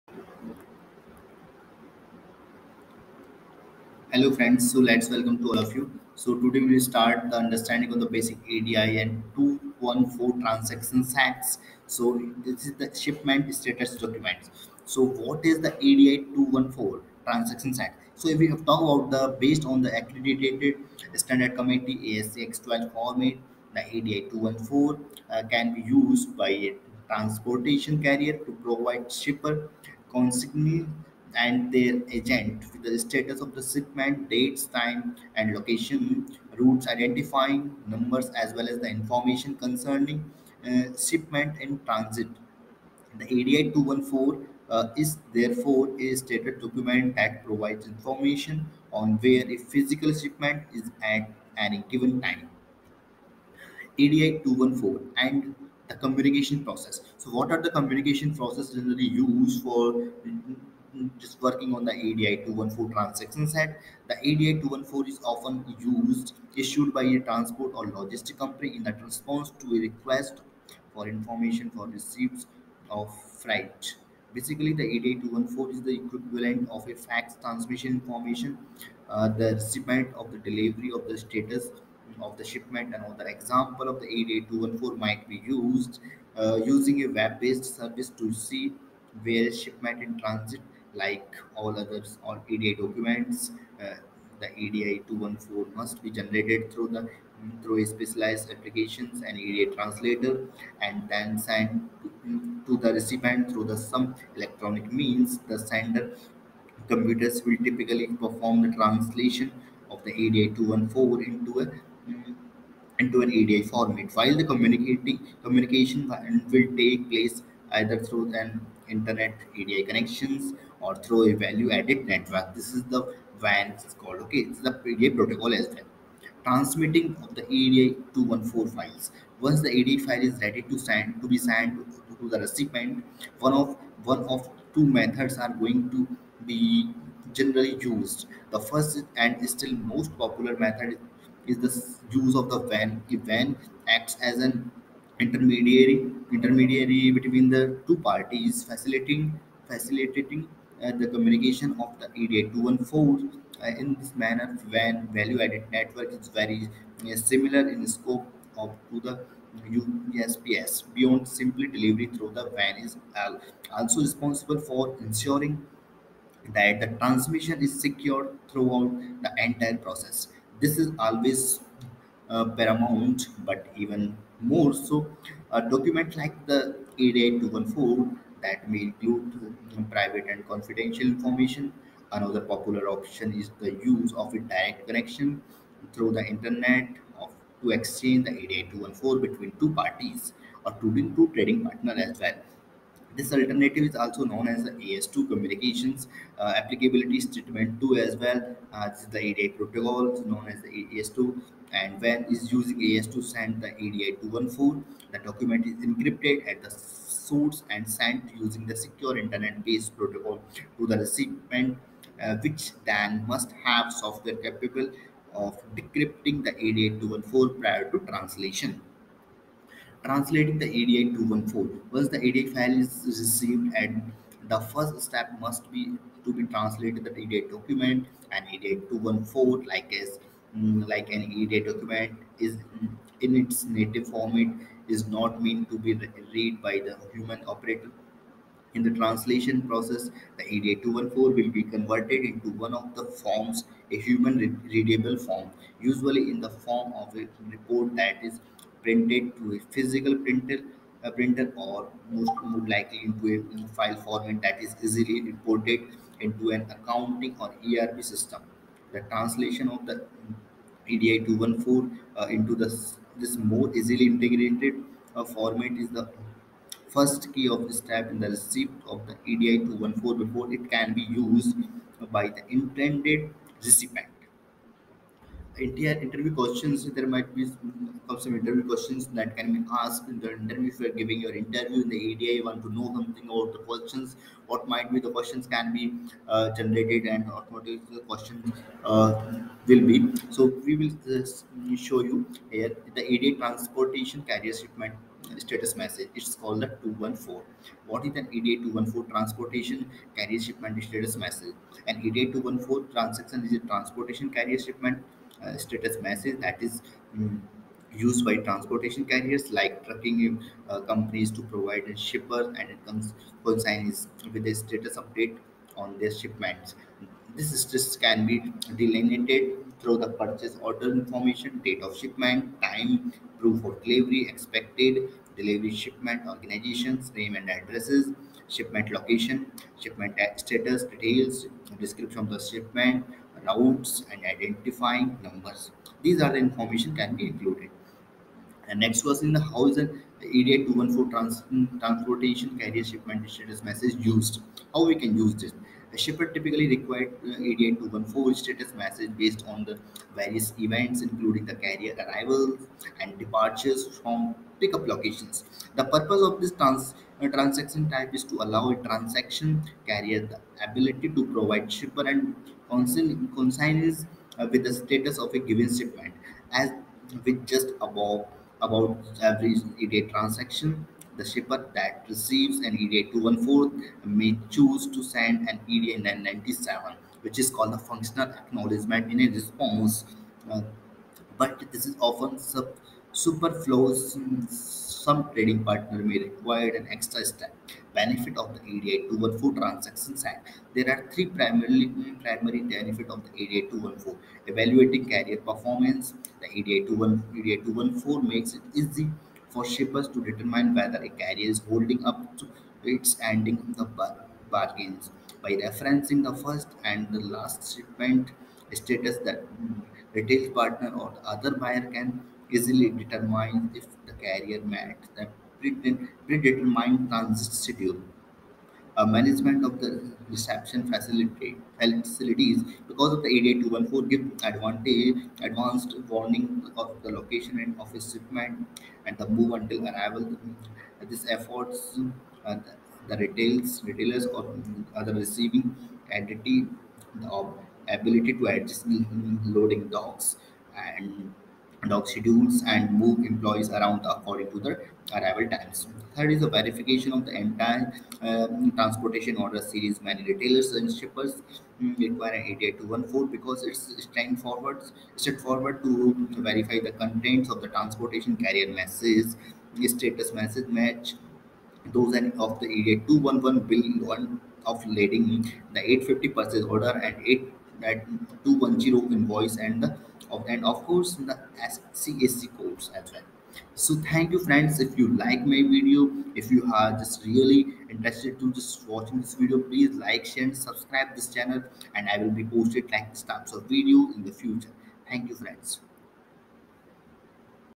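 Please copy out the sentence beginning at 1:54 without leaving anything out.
While the communicating communication will take place either through an internet EDI connections or through a value added network.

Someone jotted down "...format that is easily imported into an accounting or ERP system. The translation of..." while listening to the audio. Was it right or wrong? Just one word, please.
right.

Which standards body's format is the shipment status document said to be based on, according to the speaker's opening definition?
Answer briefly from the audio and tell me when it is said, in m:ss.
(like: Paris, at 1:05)
ASC X12, at 0:22.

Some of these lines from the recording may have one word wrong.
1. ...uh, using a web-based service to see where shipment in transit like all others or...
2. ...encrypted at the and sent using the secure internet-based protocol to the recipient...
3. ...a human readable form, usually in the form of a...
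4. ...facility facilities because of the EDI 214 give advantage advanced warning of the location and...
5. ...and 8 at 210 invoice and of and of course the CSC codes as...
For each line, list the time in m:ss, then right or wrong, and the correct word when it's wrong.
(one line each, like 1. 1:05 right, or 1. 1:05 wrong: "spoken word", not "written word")
1. 1:26 right
2. 3:25 right
3. 4:03 right
4. 7:00 right
5. 7:47 right.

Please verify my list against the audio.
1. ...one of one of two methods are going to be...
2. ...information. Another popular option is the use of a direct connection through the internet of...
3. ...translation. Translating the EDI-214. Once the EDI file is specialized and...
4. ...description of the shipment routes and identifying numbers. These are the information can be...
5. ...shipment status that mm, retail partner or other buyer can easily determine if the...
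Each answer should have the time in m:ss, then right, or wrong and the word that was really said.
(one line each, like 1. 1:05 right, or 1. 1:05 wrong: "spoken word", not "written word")
1. 2:13 right
2. 3:01 right
3. 3:37 wrong: "received", not "specialized"
4. 5:31 right
5. 6:47 right.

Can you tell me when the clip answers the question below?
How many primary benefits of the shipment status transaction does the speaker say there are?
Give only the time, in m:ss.
6:31.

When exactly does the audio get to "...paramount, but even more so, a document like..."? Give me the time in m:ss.
2:52.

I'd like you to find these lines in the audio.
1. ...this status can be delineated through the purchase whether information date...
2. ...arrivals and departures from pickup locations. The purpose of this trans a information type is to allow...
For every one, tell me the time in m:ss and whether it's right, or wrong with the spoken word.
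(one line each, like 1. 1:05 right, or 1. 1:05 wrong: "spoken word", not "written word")
1. 5:17 wrong: "order", not "whether"
2. 5:51 wrong: "transaction", not "information".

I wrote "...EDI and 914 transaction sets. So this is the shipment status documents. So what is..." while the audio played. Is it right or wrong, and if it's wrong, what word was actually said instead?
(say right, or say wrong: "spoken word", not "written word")
wrong: "214", not "914".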